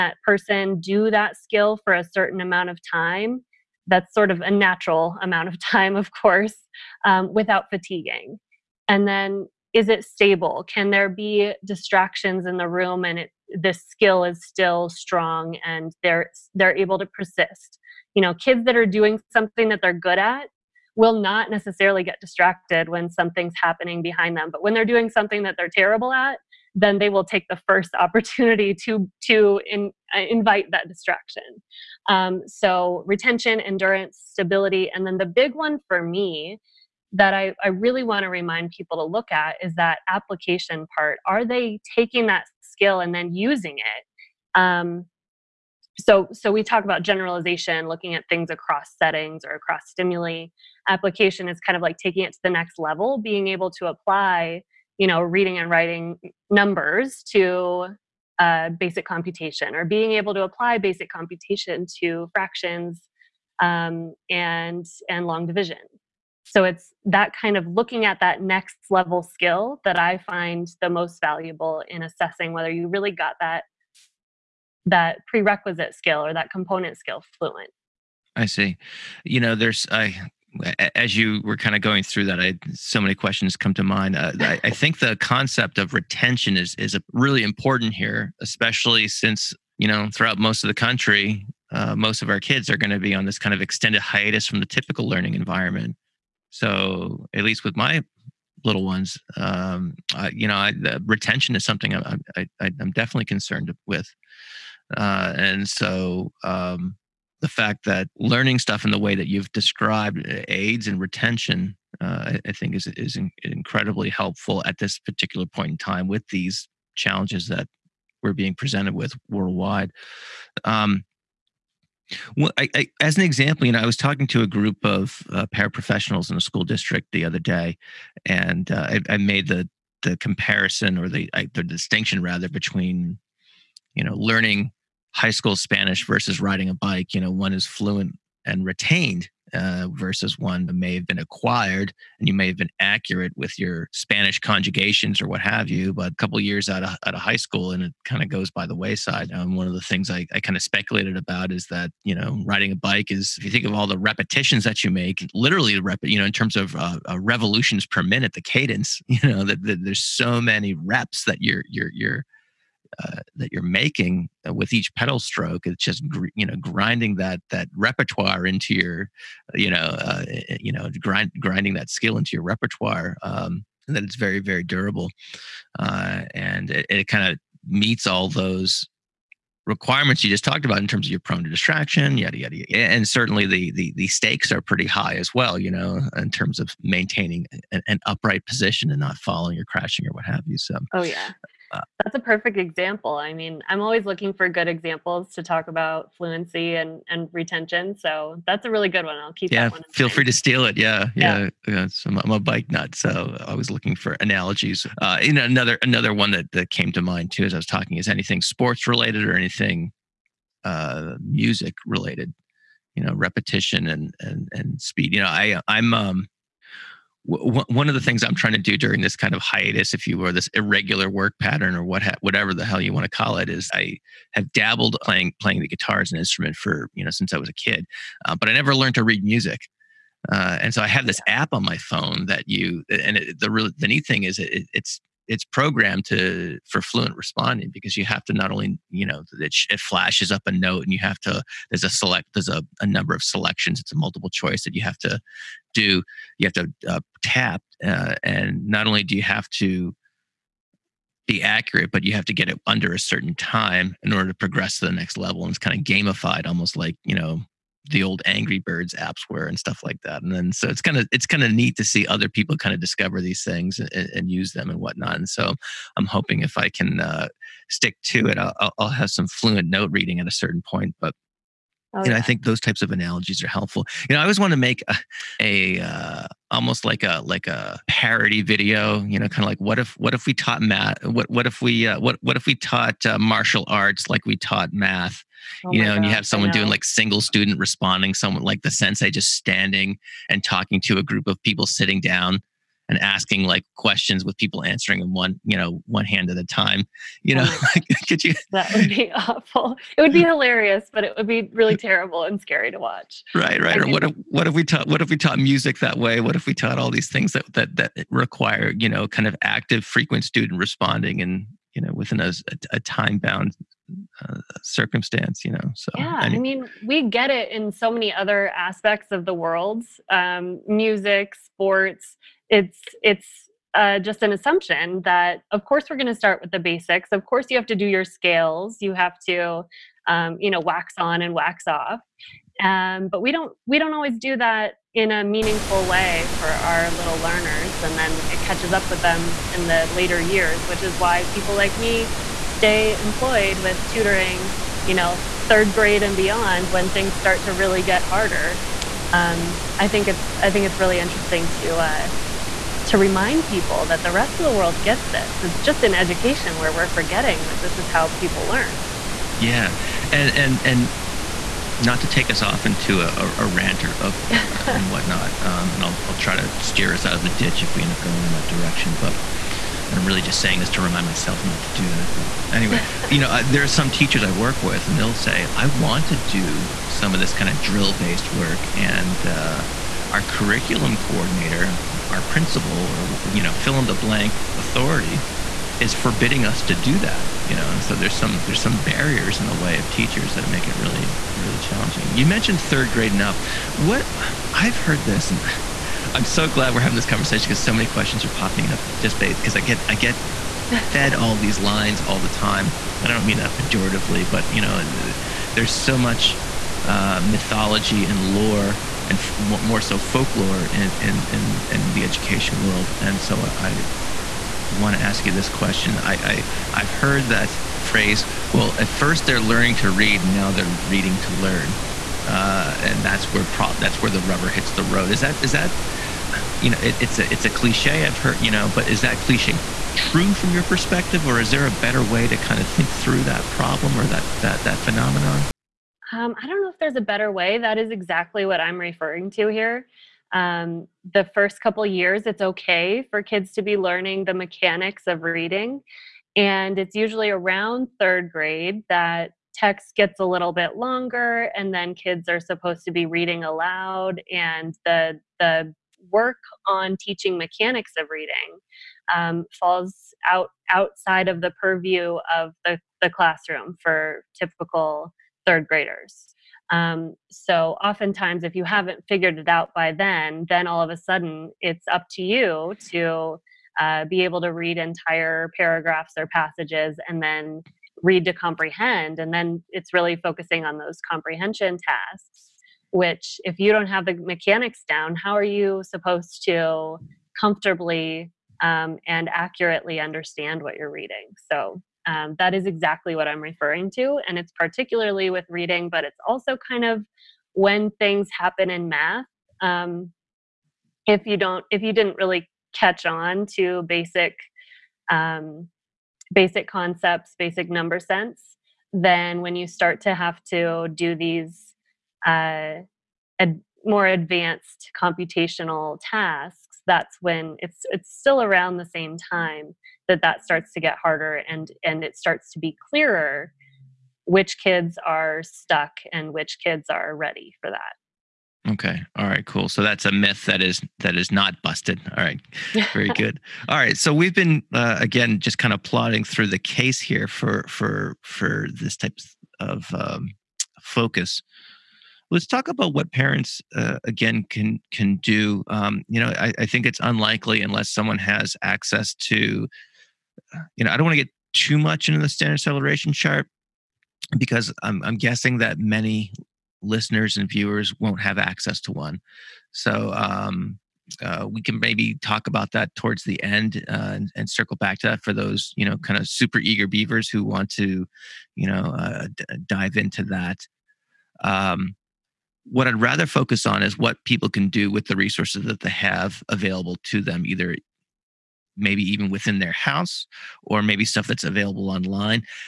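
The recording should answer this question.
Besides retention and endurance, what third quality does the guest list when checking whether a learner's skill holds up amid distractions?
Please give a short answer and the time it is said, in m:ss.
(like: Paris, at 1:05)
Stability, at 0:34.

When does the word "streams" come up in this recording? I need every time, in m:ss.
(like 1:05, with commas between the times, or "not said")
not said.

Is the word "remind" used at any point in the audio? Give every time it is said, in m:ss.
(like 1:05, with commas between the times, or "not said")
0:38, 5:52, 6:10.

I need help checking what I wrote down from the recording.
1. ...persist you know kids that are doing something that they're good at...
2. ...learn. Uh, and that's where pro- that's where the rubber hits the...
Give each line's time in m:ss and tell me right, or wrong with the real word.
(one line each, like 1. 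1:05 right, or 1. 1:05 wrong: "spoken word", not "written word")
1. 0:17 right
2. 7:01 right.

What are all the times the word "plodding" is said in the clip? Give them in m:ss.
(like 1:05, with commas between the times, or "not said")
8:55.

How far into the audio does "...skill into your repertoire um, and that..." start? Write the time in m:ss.
2:51.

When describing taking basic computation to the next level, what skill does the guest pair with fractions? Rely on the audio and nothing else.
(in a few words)
Long division.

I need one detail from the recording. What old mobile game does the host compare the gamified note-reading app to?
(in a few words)
Angry Birds.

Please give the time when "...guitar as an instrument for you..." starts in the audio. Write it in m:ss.
3:45.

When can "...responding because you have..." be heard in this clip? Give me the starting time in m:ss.
3:57.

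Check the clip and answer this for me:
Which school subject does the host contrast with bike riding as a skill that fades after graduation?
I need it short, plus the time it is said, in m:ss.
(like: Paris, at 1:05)
High school Spanish, at 2:15.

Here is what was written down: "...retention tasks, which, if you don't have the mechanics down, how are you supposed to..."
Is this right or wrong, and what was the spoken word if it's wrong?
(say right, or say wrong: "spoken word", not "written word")
wrong: "comprehension", not "retention".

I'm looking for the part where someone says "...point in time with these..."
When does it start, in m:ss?
1:55.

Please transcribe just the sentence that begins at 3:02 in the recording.
and certainly the, the, the stakes are pretty high as well.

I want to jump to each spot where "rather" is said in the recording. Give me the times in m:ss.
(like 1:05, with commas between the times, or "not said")
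2:12, 9:33.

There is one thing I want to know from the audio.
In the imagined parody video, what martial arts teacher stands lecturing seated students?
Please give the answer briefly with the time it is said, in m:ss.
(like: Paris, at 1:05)
The sensei, at 4:48.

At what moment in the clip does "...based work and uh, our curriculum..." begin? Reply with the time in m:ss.
6:17.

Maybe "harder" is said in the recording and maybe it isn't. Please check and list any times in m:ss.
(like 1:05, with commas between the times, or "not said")
5:48, 8:40.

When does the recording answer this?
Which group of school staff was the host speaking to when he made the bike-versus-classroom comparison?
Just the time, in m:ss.
2:05.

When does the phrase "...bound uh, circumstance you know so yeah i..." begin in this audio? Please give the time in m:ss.
5:13.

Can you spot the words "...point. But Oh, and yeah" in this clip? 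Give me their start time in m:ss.
4:30.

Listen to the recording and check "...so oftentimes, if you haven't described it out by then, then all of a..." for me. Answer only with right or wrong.
wrong.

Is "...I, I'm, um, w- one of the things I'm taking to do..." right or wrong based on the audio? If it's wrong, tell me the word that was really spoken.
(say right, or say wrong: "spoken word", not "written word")
wrong: "trying", not "taking".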